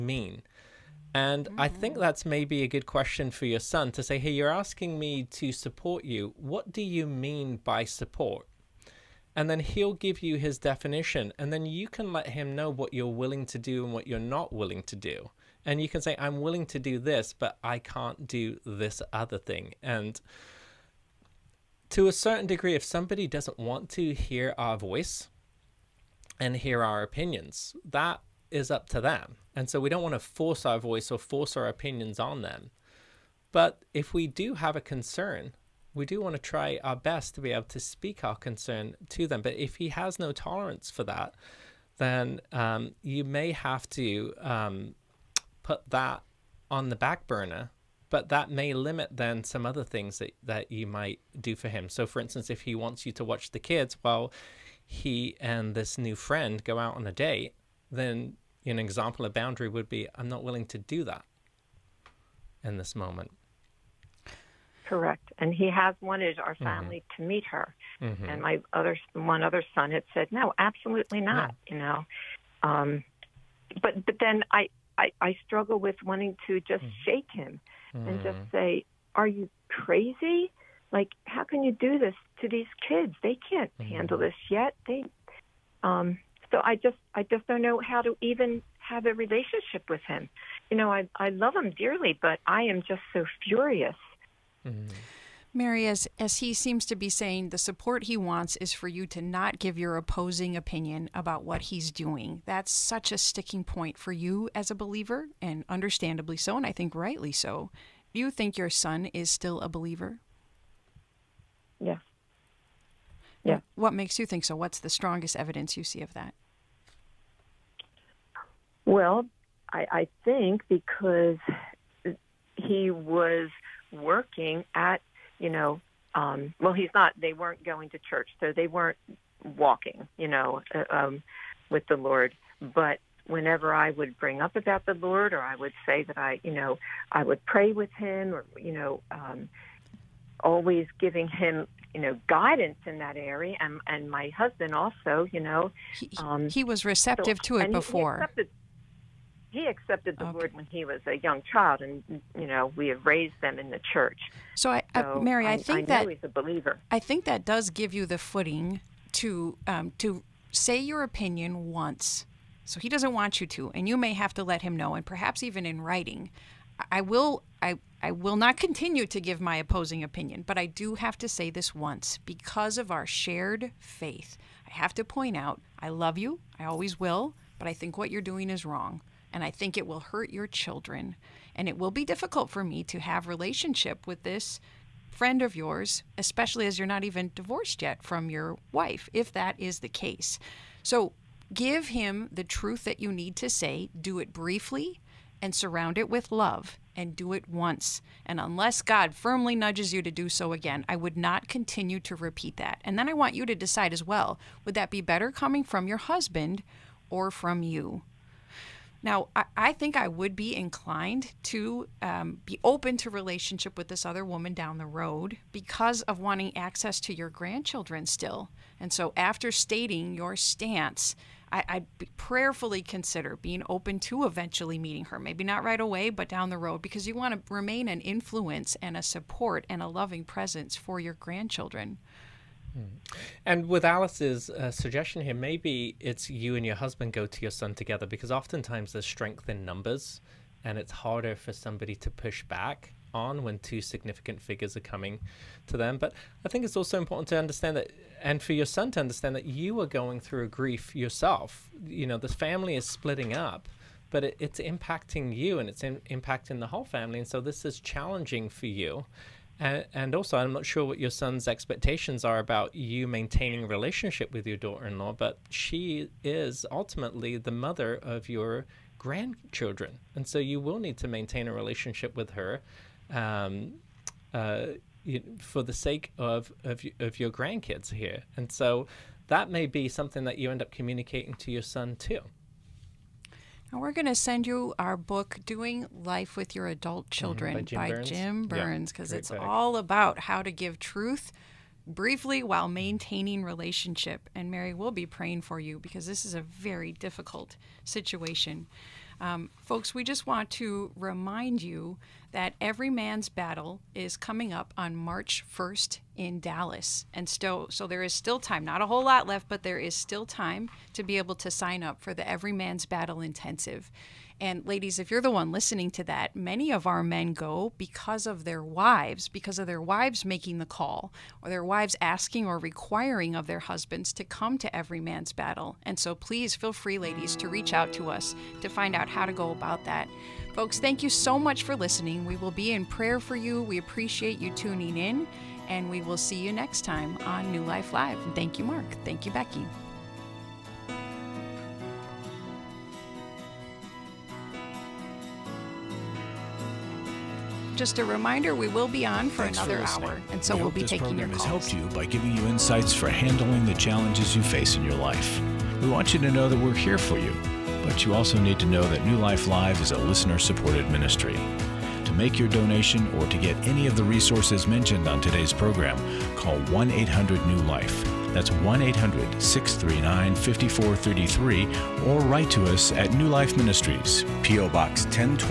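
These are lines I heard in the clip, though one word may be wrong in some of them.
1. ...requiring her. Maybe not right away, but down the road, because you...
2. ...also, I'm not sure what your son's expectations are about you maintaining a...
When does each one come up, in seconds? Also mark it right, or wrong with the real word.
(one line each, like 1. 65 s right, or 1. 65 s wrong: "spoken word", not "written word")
1. 224 s wrong: "meeting", not "requiring"
2. 260 s right.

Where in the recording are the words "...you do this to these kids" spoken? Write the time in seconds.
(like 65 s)
81 s.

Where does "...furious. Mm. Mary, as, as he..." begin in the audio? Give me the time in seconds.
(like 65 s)
93 s.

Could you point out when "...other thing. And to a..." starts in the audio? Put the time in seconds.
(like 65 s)
19 s.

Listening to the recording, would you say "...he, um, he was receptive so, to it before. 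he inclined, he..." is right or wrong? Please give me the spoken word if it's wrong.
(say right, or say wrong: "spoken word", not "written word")
wrong: "accepted", not "inclined".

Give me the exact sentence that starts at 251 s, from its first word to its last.
You know, the family is splitting up.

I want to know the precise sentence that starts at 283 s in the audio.
And we're going to send you our book, Doing Life with Your Adult mm-hmm.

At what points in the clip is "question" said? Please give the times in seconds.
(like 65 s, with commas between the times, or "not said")
2 s.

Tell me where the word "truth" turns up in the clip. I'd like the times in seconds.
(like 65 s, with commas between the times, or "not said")
192 s, 290 s.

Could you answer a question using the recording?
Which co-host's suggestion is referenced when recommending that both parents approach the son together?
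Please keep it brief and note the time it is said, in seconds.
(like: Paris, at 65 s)
Alice, at 233 s.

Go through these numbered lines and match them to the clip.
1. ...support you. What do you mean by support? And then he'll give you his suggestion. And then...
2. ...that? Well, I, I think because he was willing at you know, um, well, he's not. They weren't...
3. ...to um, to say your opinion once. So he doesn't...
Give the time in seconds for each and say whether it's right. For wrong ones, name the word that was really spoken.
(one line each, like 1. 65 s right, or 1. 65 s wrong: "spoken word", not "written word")
1. 5 s wrong: "definition", not "suggestion"
2. 116 s wrong: "working", not "willing"
3. 159 s right.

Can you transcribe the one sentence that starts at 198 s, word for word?
And unless God firmly nudges you to do so again, I would not continue to repeat that.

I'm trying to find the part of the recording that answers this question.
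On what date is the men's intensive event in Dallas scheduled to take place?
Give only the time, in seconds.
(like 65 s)
304 s.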